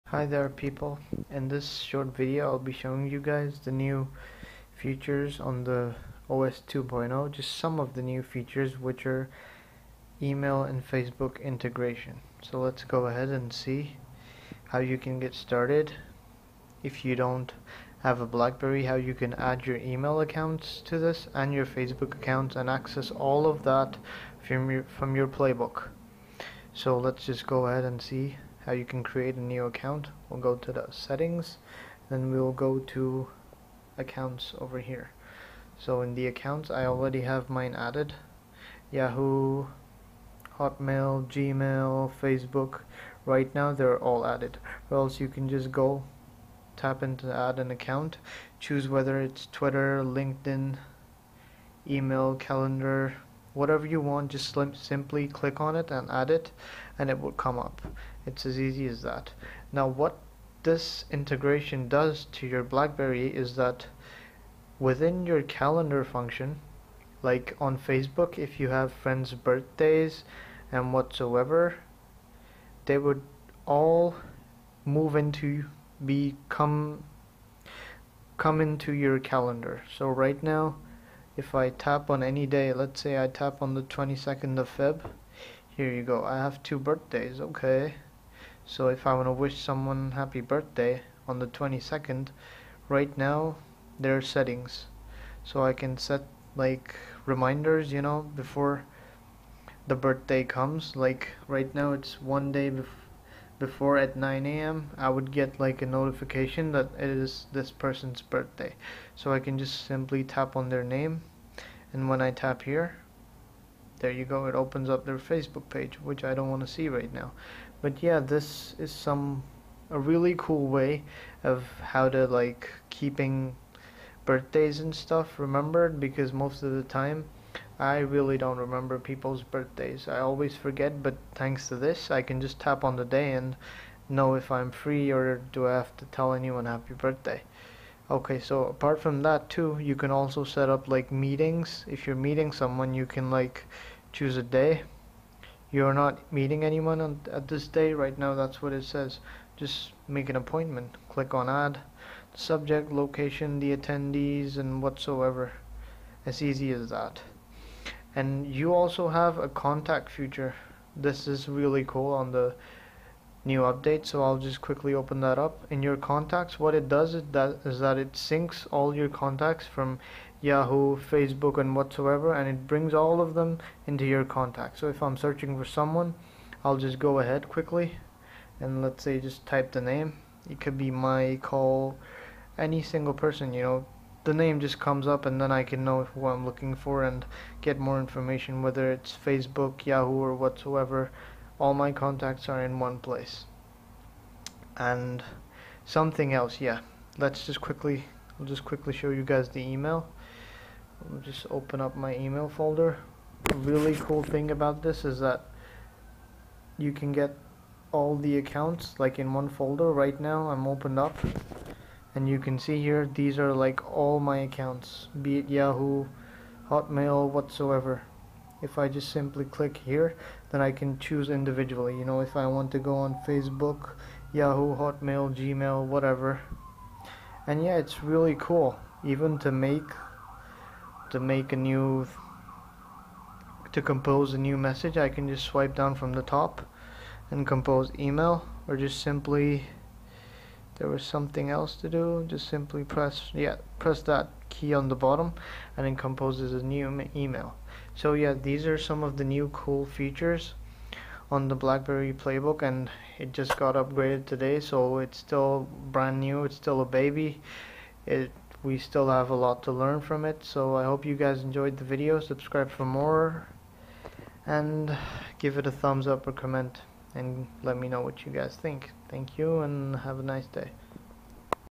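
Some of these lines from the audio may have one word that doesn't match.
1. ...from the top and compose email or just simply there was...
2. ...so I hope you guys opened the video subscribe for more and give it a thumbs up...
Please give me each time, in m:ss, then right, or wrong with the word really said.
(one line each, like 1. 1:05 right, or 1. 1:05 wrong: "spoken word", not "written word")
1. 3:55 right
2. 4:20 wrong: "enjoyed", not "opened".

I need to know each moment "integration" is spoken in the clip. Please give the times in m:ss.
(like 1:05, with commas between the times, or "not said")
0:11, 1:01.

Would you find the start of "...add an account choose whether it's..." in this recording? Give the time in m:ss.
0:47.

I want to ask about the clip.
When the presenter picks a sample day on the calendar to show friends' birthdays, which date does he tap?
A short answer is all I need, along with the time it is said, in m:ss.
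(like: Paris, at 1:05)
22nd of February, at 1:23.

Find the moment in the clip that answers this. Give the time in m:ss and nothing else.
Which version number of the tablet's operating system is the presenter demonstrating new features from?
0:06.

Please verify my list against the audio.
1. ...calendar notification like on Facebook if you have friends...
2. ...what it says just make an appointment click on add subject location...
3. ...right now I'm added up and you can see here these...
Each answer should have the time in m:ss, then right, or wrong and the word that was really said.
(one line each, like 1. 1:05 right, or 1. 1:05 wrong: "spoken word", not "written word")
1. 1:05 wrong: "function", not "notification"
2. 2:28 right
3. 3:29 wrong: "opened", not "added".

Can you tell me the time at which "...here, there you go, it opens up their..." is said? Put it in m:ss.
1:52.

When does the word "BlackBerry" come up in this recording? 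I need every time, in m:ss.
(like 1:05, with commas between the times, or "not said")
0:18, 1:02, 4:11.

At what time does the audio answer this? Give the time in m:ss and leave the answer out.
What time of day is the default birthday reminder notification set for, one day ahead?
1:44.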